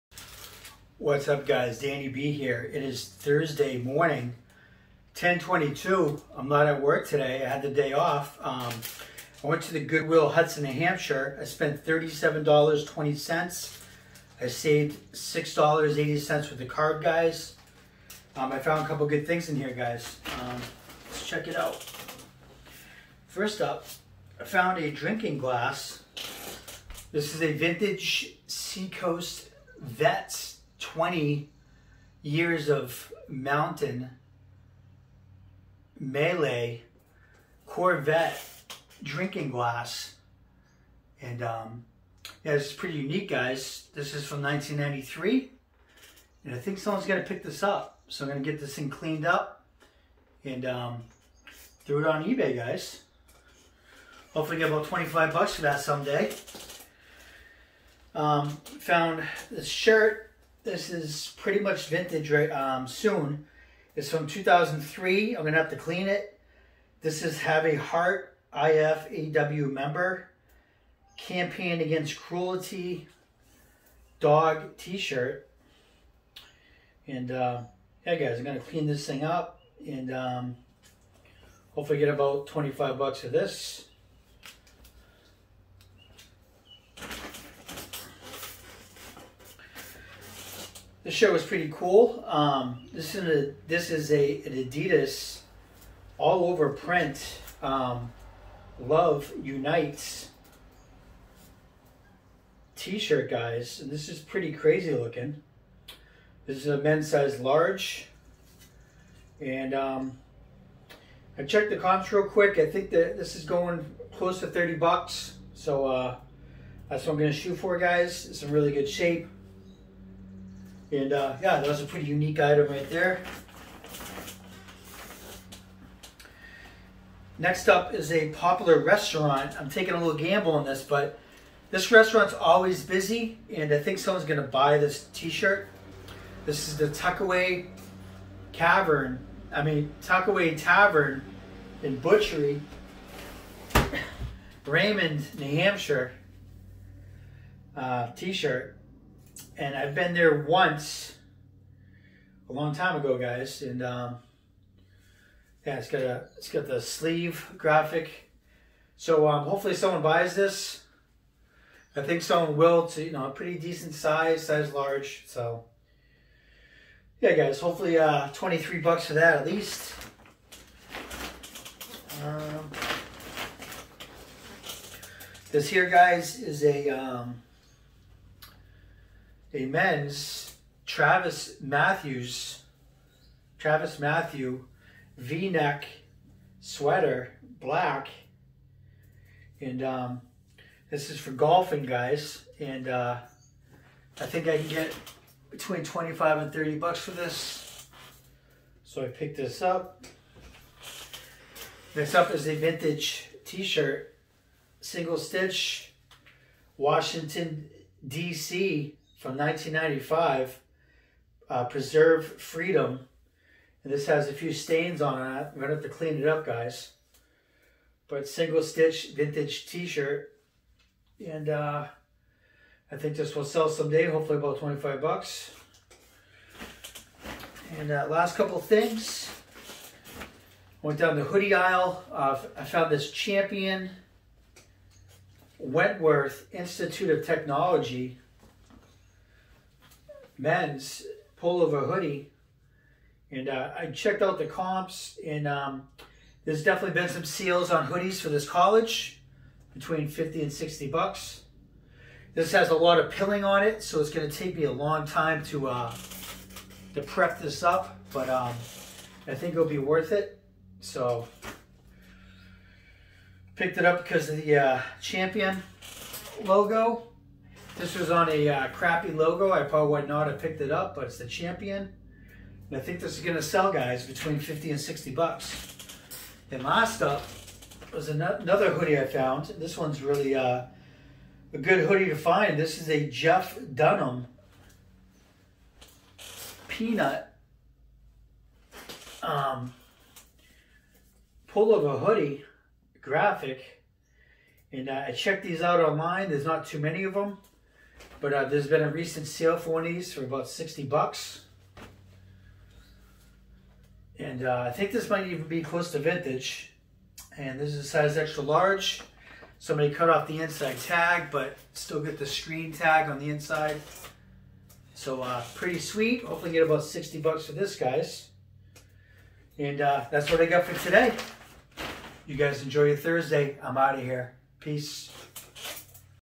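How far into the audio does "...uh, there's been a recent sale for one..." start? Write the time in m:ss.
4:58.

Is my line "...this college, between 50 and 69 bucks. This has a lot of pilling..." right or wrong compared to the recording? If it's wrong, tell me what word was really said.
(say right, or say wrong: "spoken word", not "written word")
wrong: "60", not "69".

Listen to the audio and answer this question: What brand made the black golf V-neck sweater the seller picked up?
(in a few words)
Travis Matthew.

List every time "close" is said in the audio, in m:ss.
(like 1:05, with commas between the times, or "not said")
1:54, 5:05.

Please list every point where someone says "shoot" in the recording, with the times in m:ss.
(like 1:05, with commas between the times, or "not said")
1:57.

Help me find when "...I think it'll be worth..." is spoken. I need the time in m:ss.
4:19.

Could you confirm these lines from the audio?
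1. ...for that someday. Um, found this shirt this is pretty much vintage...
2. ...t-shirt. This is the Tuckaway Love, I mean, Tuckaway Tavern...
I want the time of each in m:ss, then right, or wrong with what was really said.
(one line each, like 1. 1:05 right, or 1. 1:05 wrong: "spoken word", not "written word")
1. 0:55 right
2. 2:15 wrong: "Cavern", not "Love".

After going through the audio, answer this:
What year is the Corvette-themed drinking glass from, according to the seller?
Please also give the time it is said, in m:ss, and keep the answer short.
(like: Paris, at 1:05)
1993, at 0:44.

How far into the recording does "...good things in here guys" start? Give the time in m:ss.
0:19.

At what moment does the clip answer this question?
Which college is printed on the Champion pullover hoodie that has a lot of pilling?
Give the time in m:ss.
3:55.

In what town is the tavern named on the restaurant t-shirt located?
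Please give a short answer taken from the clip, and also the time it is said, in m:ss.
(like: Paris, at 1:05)
Raymond, New Hampshire, at 2:24.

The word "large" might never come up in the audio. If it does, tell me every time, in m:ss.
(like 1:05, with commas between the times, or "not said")
1:47, 2:44, 5:08.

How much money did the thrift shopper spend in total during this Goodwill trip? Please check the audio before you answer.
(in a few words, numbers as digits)
$37.20.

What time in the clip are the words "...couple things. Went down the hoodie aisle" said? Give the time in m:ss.
3:48.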